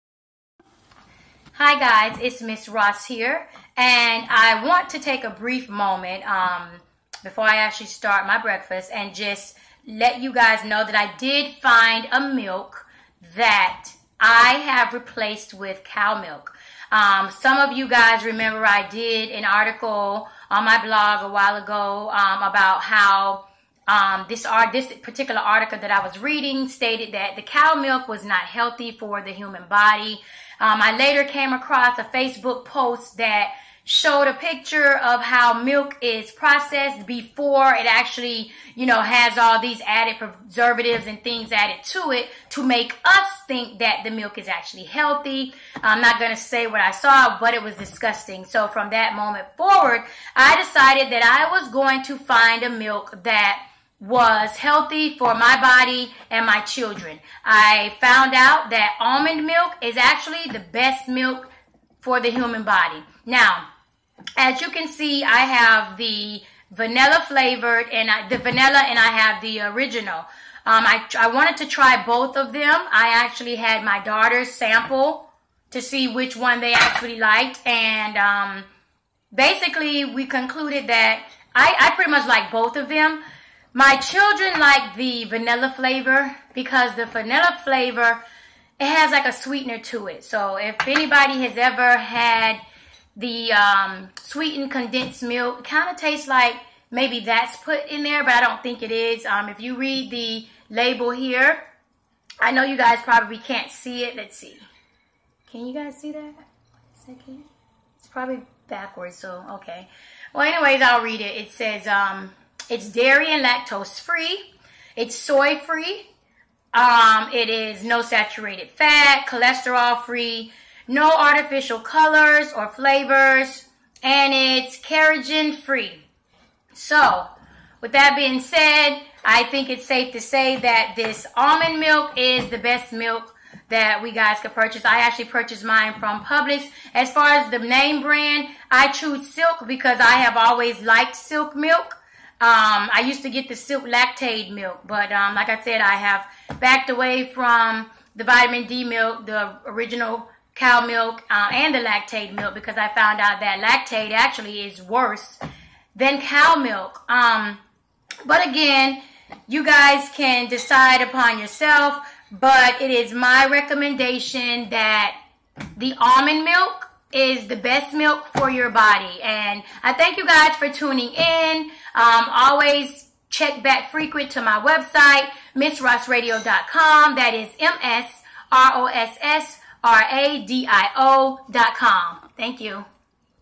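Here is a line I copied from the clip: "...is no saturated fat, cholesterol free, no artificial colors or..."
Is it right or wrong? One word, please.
right.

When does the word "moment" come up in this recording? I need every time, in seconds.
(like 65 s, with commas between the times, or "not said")
5 s, 49 s.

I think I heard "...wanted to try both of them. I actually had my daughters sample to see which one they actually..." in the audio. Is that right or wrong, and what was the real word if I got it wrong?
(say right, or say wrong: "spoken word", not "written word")
right.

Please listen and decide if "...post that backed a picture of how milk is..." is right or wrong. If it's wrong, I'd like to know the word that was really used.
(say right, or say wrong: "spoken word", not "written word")
wrong: "showed", not "backed".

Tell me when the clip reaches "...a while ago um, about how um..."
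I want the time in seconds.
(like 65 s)
21 s.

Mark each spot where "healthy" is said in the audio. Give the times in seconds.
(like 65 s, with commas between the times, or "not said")
28 s, 44 s, 54 s.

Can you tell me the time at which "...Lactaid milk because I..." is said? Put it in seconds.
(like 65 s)
151 s.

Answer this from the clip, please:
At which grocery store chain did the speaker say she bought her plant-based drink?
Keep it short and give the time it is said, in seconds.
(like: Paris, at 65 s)
Publix, at 136 s.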